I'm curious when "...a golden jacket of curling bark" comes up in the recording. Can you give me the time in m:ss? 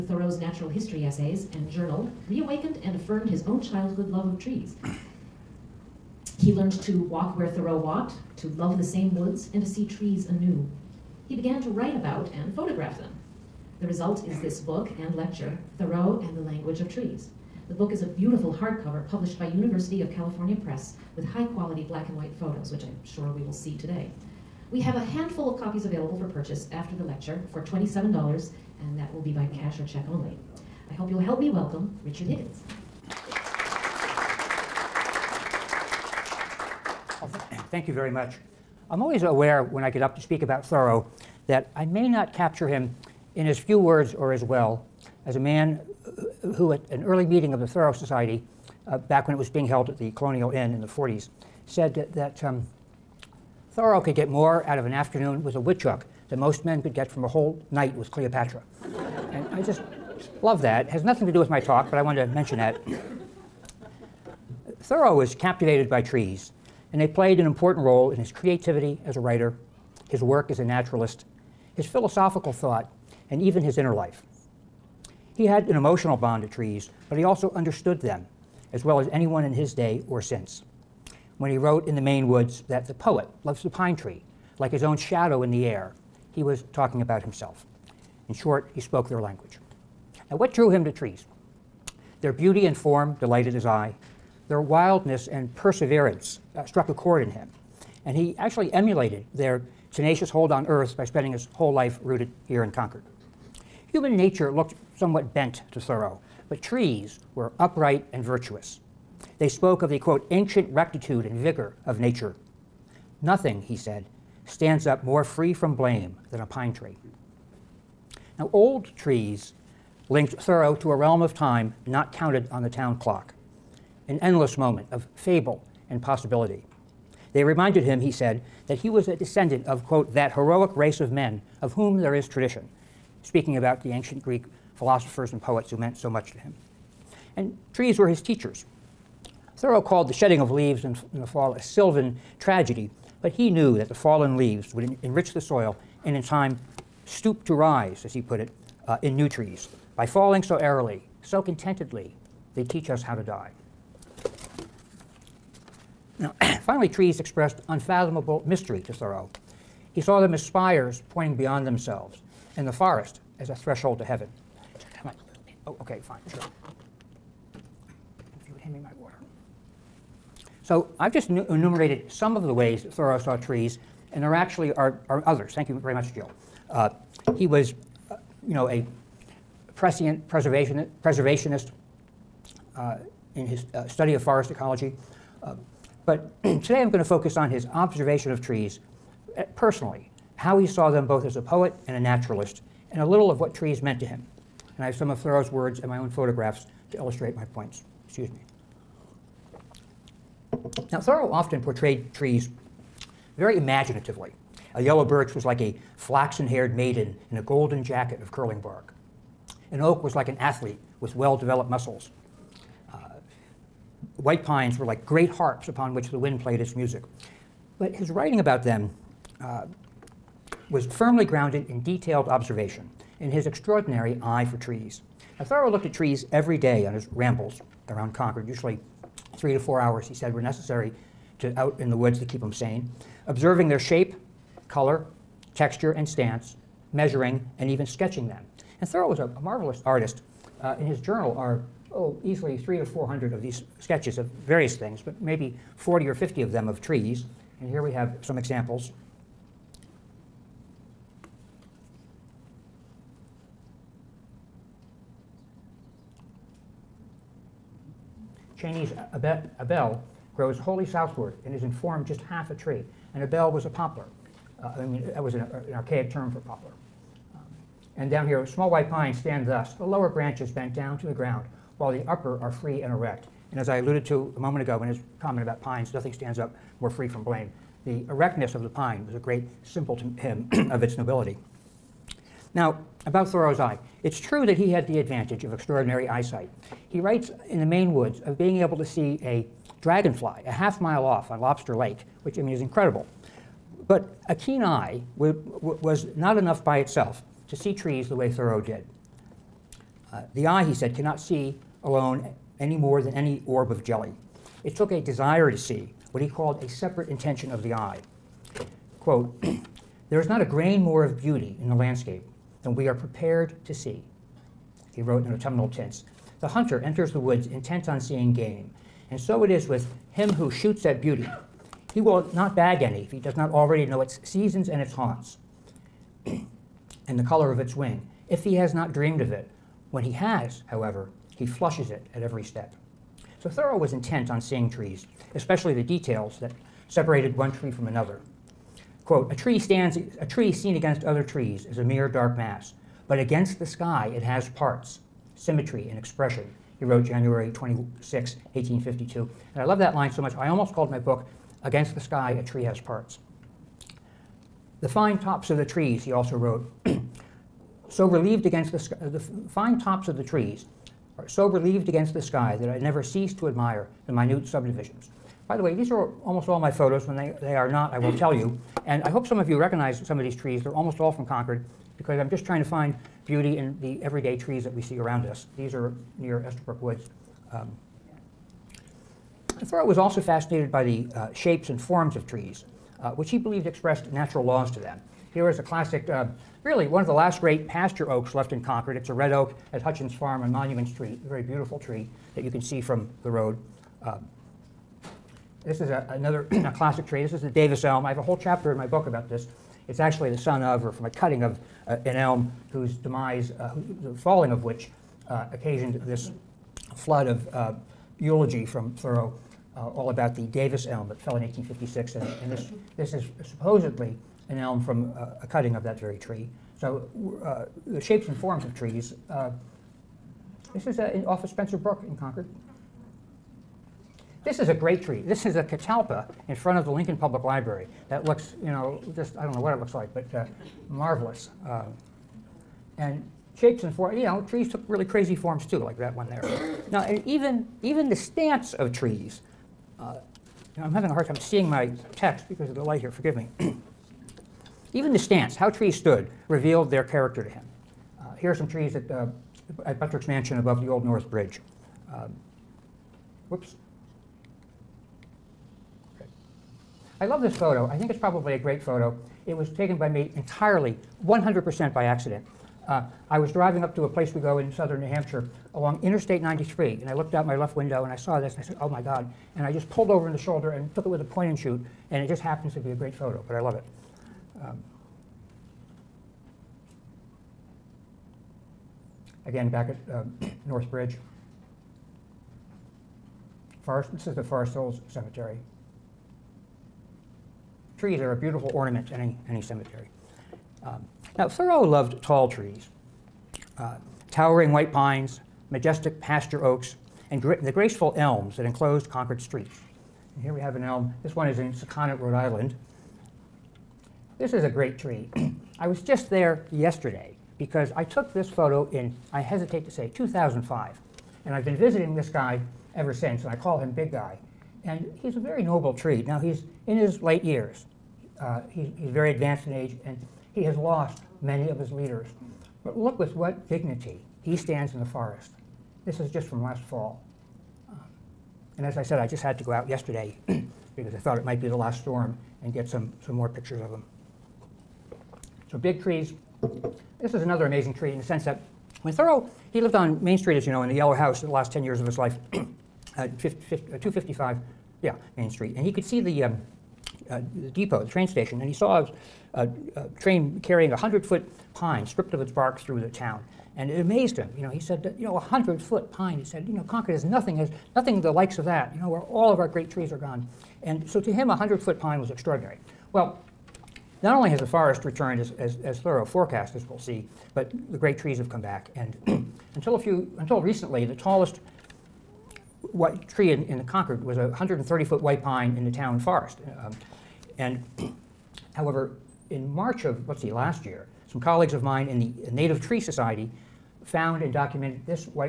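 3:27.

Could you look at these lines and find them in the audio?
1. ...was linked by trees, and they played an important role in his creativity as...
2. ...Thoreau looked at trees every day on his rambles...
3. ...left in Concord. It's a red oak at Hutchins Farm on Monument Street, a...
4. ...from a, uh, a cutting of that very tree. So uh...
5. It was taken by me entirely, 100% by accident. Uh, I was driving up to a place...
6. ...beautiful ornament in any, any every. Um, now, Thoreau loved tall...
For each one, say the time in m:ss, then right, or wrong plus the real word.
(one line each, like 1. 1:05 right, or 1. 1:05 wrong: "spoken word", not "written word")
1. 1:05 wrong: "captivated", not "linked"
2. 3:45 right
3. 6:28 right
4. 6:54 right
5. 7:39 right
6. 8:08 wrong: "cemetery", not "every".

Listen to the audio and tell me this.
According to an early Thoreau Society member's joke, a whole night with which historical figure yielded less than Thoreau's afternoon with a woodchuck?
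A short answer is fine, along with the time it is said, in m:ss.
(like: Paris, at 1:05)
Cleopatra, at 0:58.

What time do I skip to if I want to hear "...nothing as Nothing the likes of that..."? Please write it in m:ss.
9:17.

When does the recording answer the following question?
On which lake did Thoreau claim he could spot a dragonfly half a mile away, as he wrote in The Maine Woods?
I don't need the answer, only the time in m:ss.
4:51.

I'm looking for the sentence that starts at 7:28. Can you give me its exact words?
Uh, here are some trees that uh, at Buttrick's Mansion above the Old North Bridge.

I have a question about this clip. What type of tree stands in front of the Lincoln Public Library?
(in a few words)
catalpa.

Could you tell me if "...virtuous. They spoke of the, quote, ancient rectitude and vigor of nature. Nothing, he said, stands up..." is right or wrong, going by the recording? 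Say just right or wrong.
right.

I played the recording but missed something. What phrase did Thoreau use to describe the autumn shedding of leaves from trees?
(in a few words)
a sylvan tragedy.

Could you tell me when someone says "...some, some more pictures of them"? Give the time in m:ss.
8:52.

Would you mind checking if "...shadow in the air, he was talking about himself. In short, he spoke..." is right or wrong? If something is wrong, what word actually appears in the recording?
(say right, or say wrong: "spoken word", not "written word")
right.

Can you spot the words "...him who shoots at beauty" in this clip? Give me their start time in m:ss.
5:20.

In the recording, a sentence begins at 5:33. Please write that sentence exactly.
So Thoreau was intent on seeing trees, especially the details that separated one tree from another.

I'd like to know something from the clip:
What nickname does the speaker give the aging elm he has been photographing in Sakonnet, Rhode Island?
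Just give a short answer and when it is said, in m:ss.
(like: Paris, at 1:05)
Big Guy, at 8:33.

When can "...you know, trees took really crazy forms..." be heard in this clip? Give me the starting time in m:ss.
7:14.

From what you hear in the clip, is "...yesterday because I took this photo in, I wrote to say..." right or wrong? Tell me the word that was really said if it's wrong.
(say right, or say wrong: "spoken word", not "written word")
wrong: "hesitate", not "wrote".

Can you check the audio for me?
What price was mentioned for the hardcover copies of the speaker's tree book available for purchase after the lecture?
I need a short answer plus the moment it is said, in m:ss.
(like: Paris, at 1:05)
$27, at 0:27.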